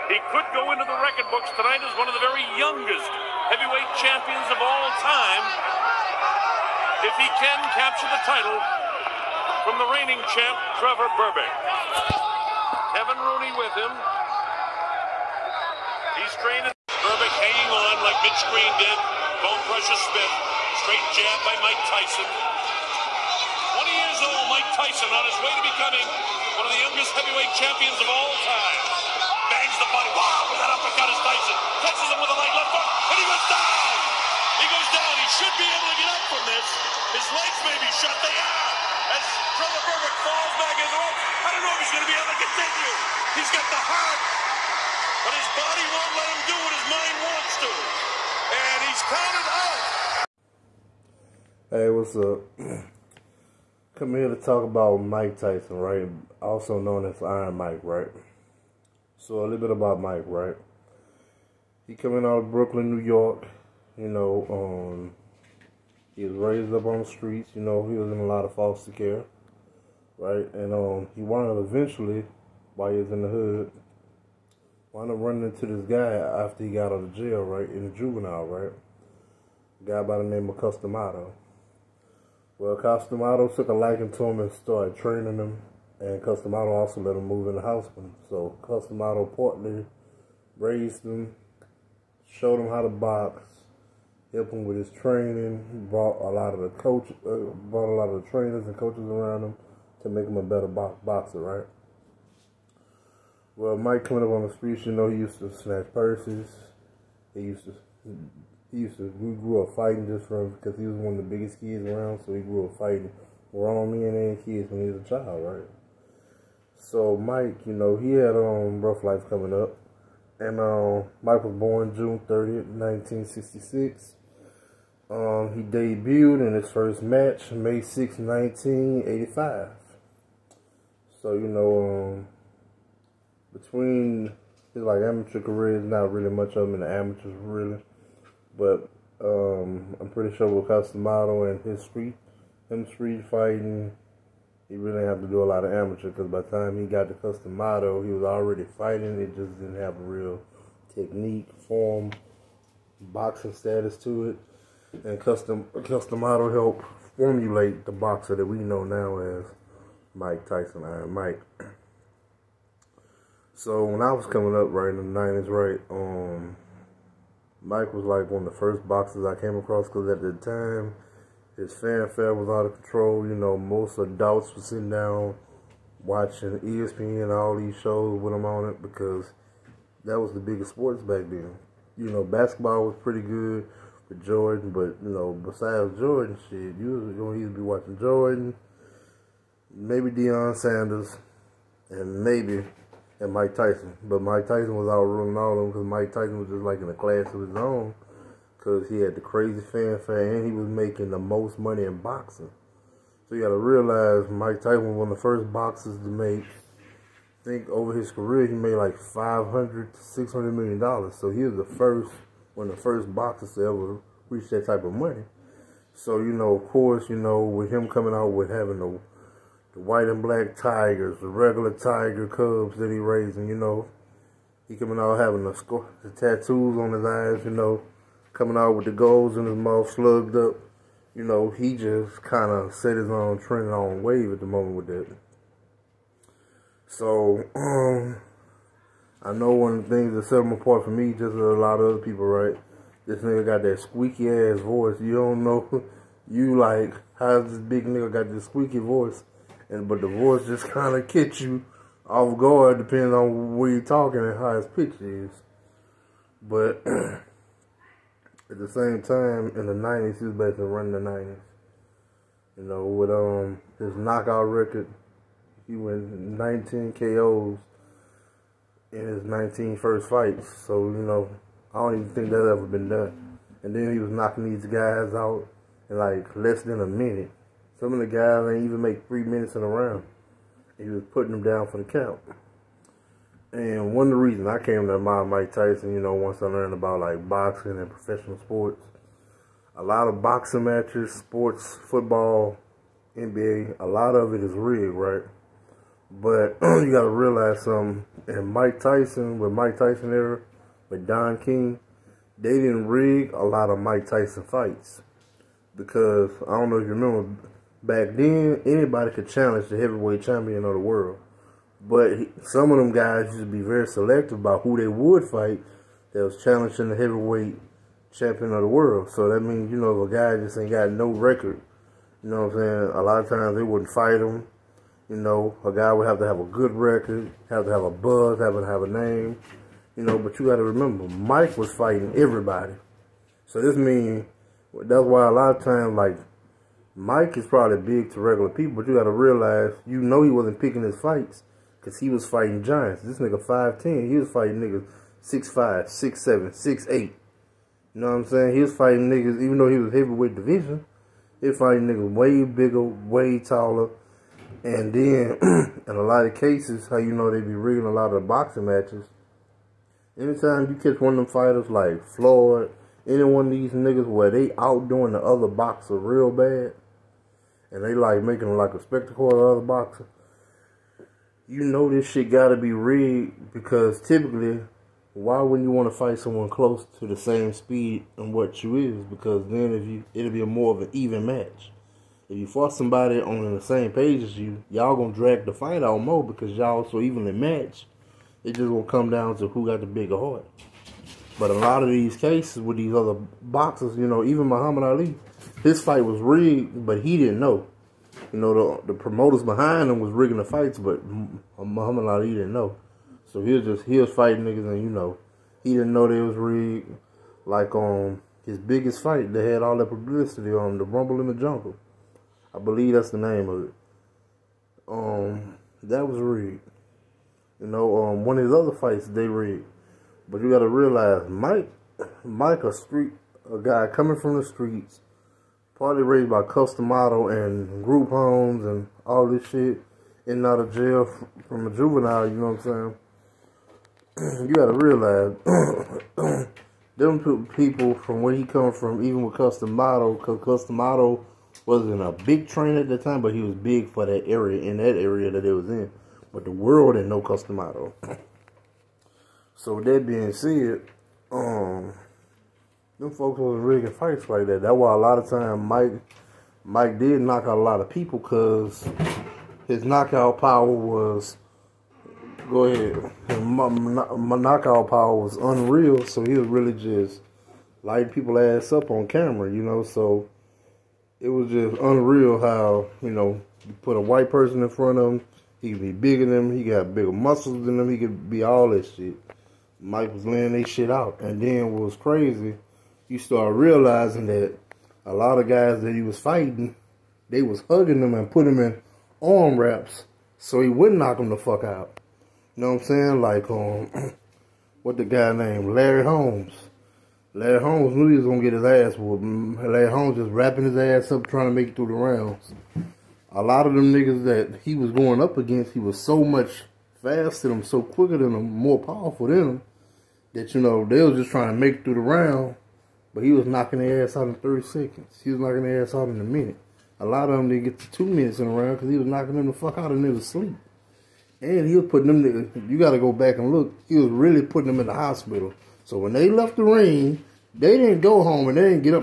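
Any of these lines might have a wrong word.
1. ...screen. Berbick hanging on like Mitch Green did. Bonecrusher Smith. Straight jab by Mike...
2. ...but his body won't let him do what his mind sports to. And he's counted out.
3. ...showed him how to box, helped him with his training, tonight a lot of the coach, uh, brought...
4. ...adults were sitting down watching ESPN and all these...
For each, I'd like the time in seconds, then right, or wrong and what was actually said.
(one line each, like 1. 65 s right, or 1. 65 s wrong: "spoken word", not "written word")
1. 16 s right
2. 45 s wrong: "wants", not "sports"
3. 92 s wrong: "brought", not "tonight"
4. 173 s right.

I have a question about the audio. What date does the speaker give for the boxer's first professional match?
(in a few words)
May 6, 1985.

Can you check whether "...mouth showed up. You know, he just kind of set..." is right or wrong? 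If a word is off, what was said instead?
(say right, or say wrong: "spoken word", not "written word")
wrong: "slugged", not "showed".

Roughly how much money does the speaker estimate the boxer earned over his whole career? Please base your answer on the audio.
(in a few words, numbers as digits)
500 to 600 million dollars.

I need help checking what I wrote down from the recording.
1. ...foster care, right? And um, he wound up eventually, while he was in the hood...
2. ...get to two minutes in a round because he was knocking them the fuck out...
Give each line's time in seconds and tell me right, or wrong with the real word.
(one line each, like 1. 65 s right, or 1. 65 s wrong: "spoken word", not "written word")
1. 68 s right
2. 517 s right.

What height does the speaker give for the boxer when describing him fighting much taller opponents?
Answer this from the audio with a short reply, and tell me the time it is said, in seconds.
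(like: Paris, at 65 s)
5'10", at 343 s.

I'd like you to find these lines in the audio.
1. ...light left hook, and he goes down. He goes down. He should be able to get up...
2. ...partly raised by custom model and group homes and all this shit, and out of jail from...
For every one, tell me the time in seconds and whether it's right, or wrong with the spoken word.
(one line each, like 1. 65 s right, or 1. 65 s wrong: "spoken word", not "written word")
1. 32 s right
2. 425 s right.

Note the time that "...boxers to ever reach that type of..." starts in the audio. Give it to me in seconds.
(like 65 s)
213 s.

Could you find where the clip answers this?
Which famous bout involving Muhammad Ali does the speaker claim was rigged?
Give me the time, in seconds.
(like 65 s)
410 s.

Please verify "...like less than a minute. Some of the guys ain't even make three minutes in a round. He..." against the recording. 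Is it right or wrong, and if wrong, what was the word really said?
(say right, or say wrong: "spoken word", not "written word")
right.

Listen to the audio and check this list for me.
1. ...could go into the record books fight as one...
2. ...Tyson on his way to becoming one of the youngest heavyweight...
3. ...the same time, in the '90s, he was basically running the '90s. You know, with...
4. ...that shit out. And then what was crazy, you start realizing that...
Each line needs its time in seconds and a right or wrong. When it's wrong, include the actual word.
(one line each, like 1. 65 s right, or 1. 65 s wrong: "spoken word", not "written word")
1. 0 s wrong: "tonight", not "fight"
2. 24 s right
3. 258 s right
4. 480 s right.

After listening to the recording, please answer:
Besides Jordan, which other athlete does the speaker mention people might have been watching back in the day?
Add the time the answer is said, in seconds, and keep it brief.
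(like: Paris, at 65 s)
Deion Sanders, at 190 s.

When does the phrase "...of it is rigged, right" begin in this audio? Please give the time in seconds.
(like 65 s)
294 s.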